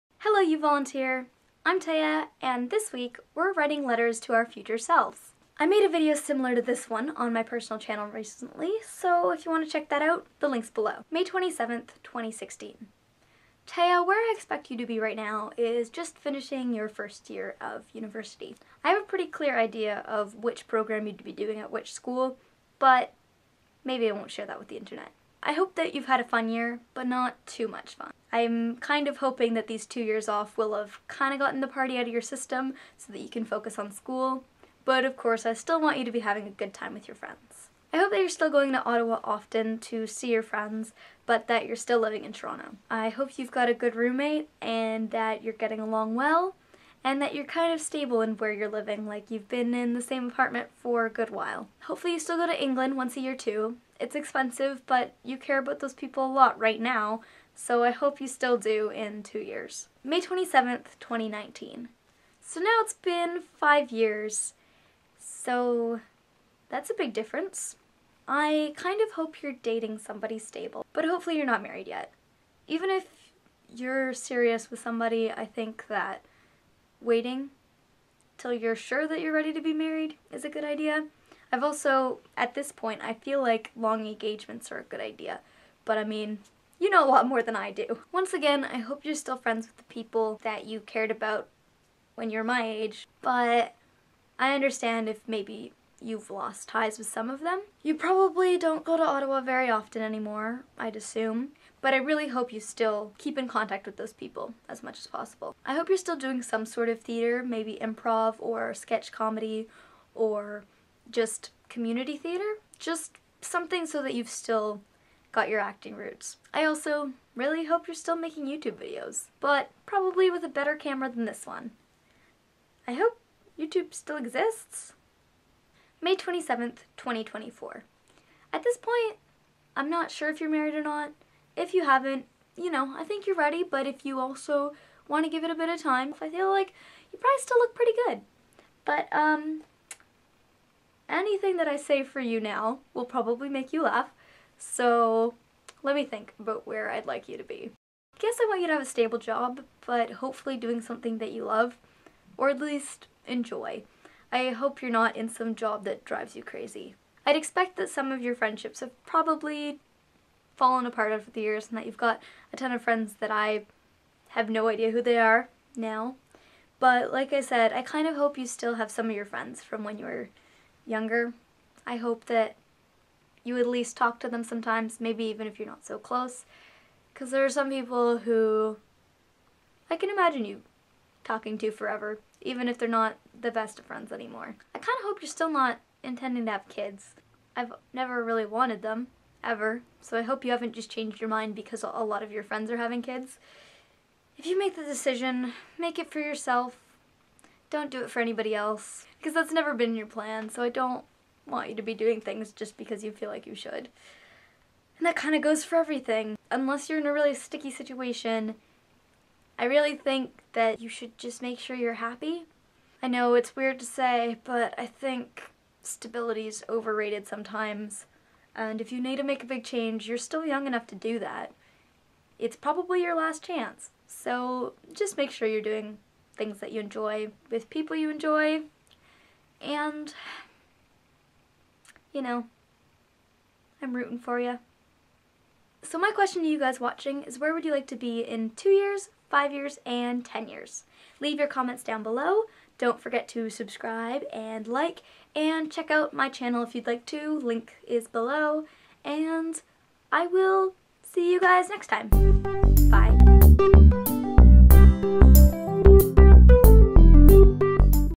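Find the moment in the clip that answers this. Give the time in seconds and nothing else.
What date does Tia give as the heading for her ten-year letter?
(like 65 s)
126 s.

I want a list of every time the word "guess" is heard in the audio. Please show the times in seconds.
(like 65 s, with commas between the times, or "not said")
148 s.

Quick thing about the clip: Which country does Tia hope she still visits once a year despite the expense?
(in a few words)
England.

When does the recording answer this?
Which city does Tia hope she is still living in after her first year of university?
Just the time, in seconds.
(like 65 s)
42 s.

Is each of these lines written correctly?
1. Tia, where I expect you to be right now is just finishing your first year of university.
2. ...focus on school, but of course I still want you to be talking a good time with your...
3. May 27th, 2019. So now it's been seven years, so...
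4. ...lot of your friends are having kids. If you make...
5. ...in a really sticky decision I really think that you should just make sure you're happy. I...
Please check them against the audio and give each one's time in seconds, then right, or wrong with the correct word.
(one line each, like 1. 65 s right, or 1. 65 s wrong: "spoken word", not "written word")
1. 13 s right
2. 33 s wrong: "having", not "talking"
3. 60 s wrong: "five", not "seven"
4. 192 s right
5. 206 s wrong: "situation", not "decision".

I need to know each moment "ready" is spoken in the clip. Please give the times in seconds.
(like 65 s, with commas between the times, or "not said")
79 s, 133 s.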